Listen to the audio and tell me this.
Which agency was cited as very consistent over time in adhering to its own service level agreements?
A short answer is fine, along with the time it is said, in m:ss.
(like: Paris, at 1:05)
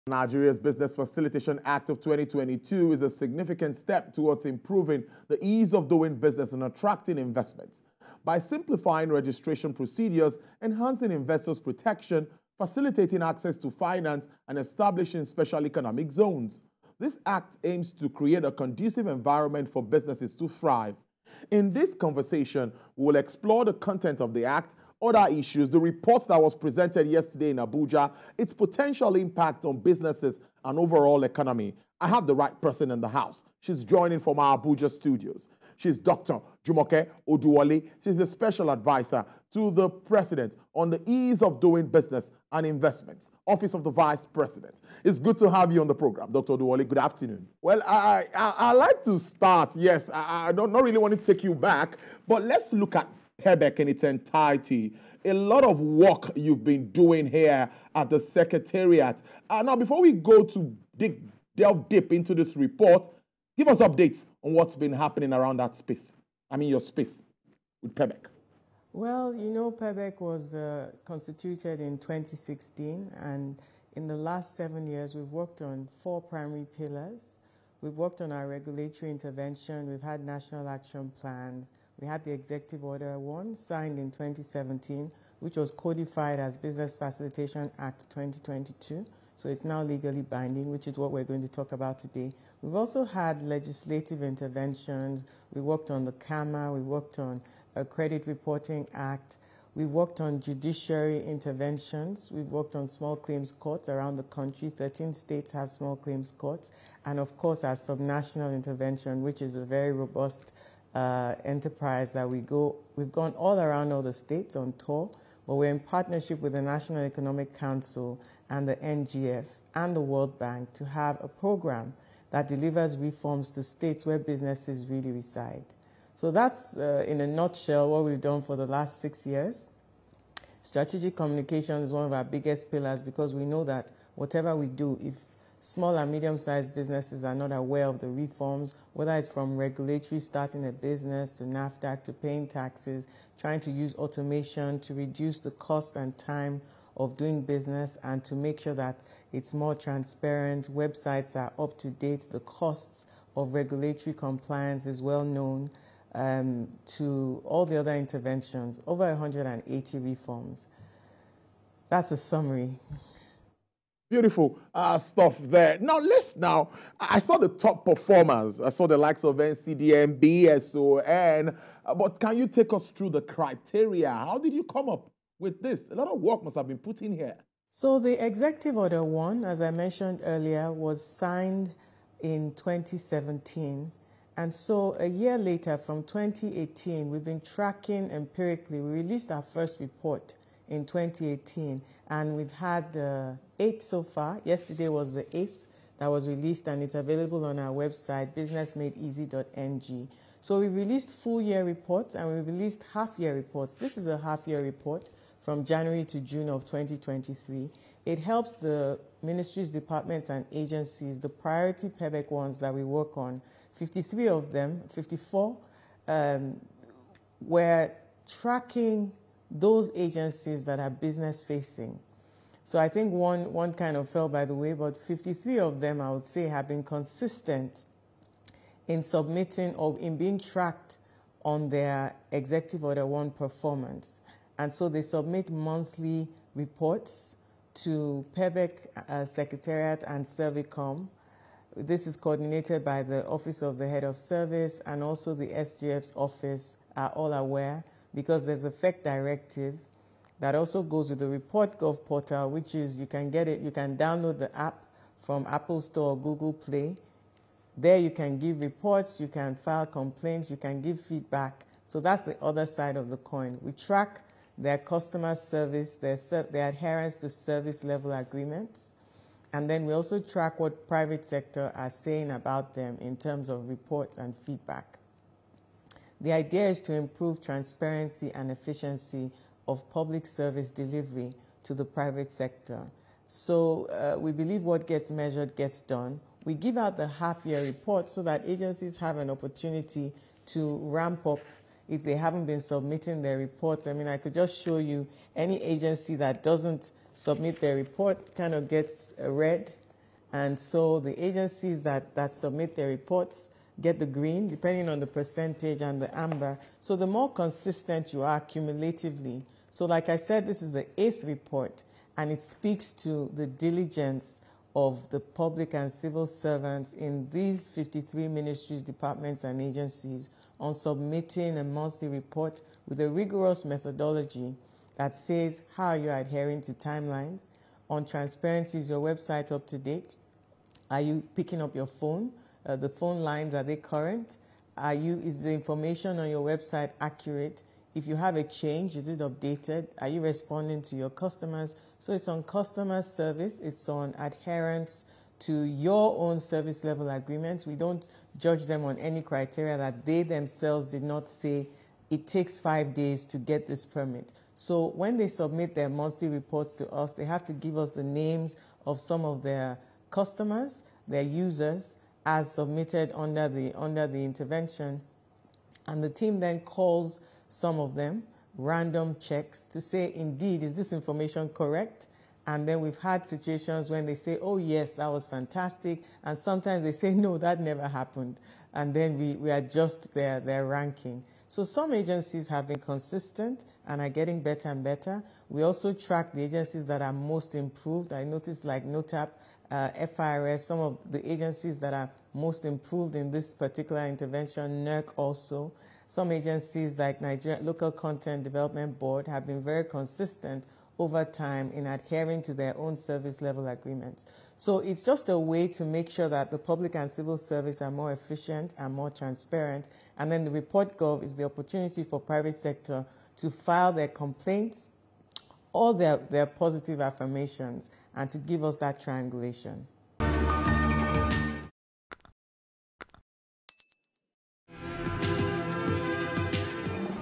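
Nigeria Local Content Development Board, at 6:37.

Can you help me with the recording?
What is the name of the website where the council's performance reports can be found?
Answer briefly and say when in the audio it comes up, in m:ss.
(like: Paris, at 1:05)
businessmadeeasy.ng, at 3:18.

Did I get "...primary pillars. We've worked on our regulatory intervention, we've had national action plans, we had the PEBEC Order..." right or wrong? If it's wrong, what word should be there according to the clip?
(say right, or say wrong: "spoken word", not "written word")
wrong: "Executive", not "PEBEC".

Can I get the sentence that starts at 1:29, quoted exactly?
So it's now legally binding, which is what we're going to talk about today.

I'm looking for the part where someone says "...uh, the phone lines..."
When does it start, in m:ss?
5:32.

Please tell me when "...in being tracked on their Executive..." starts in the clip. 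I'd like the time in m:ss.
3:49.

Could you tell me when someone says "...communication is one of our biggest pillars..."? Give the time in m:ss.
2:11.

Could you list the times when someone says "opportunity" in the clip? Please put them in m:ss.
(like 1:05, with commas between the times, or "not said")
4:49, 6:51.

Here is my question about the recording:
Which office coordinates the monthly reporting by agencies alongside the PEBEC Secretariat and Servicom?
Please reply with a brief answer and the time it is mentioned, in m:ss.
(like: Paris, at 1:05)
Office of the Head of Service, at 4:03.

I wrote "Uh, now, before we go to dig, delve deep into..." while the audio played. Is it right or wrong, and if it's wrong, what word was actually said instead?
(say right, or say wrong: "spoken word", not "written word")
right.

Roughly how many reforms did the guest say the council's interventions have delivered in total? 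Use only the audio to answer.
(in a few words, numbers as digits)
Over 180.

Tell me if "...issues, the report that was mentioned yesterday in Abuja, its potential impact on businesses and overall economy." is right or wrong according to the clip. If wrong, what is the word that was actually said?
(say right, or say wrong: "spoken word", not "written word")
wrong: "presented", not "mentioned".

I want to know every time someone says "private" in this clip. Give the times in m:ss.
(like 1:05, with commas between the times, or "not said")
4:30, 4:41, 6:52.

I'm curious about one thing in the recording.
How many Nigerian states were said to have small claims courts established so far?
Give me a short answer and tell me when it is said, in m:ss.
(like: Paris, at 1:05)
13, at 1:44.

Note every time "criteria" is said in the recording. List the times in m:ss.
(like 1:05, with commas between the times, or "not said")
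2:53, 5:49.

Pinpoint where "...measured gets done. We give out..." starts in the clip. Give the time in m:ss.
4:45.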